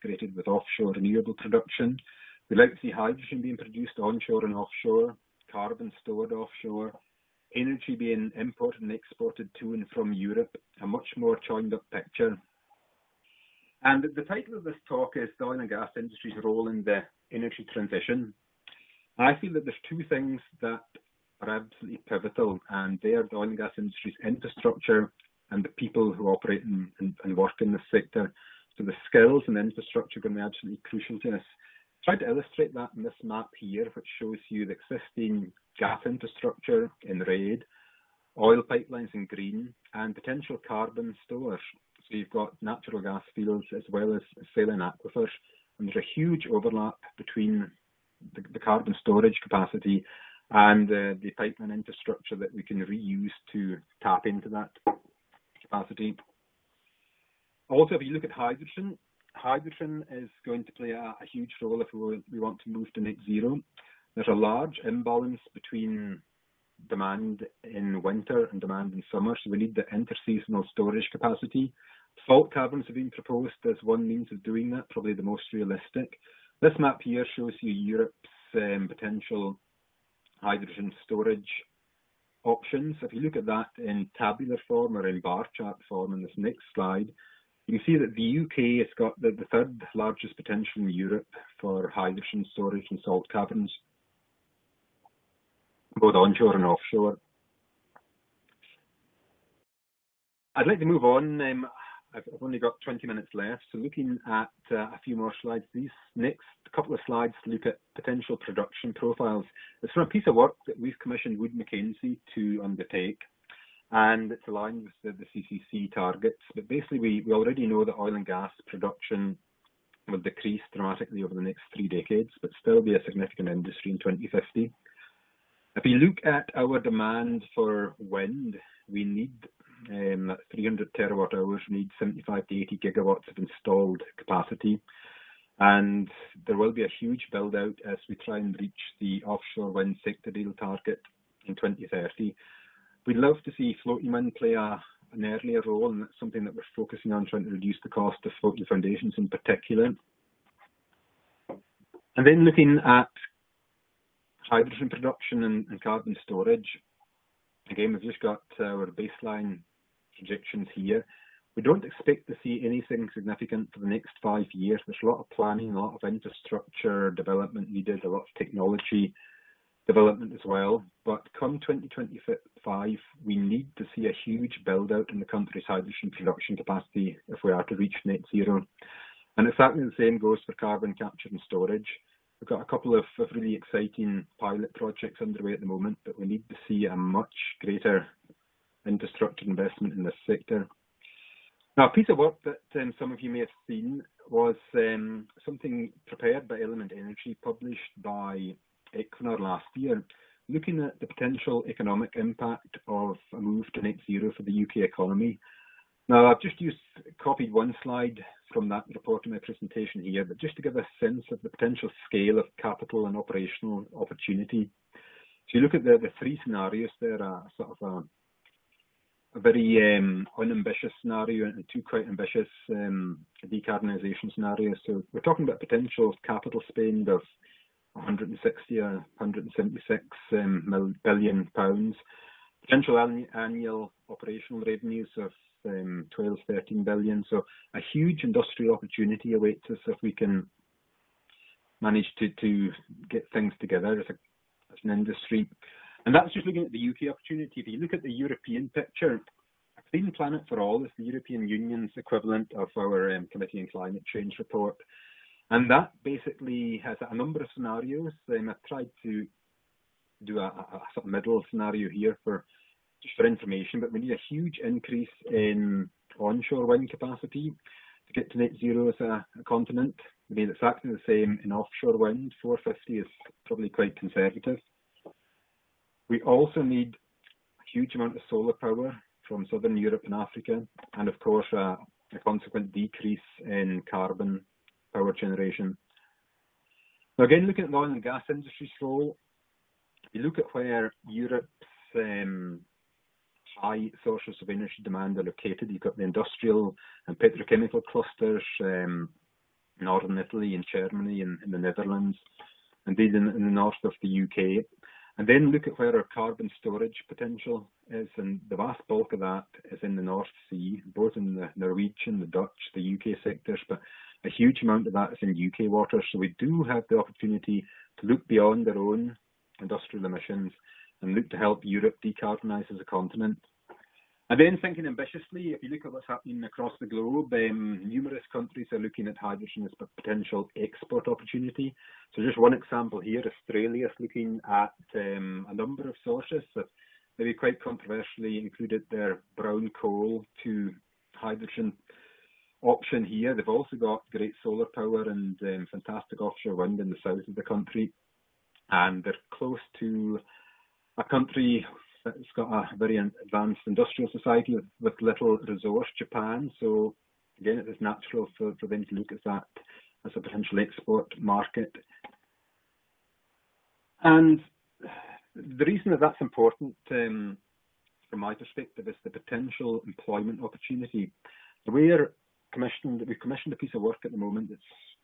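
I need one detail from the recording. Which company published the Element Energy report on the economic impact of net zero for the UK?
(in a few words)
Equinor.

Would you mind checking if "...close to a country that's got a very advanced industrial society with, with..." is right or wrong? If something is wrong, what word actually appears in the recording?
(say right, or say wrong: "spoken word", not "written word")
right.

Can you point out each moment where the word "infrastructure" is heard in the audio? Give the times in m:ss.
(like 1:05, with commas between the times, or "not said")
0:24, 0:29, 0:36, 0:51, 2:46, 3:08.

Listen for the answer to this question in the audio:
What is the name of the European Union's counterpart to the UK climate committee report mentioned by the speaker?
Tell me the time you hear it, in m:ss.
4:09.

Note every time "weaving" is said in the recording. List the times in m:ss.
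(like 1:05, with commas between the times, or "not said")
not said.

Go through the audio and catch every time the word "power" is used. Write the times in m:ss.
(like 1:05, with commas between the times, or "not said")
4:38, 4:44, 5:44.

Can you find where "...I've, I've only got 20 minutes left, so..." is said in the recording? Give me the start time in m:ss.
1:42.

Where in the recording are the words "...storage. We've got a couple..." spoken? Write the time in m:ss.
3:01.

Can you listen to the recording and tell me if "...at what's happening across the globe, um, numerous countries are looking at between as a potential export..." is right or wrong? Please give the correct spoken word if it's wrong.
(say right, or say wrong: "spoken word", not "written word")
wrong: "hydrogen", not "between".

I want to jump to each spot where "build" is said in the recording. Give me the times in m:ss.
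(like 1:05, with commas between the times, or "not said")
2:17, 2:54.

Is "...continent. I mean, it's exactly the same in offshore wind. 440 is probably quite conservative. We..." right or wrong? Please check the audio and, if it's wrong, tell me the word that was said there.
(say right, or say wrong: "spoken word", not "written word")
wrong: "450", not "440".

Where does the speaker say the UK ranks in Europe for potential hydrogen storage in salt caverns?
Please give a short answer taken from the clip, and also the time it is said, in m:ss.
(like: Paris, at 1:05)
third largest, at 1:29.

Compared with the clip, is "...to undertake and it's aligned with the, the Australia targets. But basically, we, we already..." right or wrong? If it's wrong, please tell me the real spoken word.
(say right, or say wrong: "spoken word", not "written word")
wrong: "CCC", not "Australia".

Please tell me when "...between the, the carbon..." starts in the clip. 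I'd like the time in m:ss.
0:47.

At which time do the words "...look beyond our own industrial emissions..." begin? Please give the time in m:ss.
5:18.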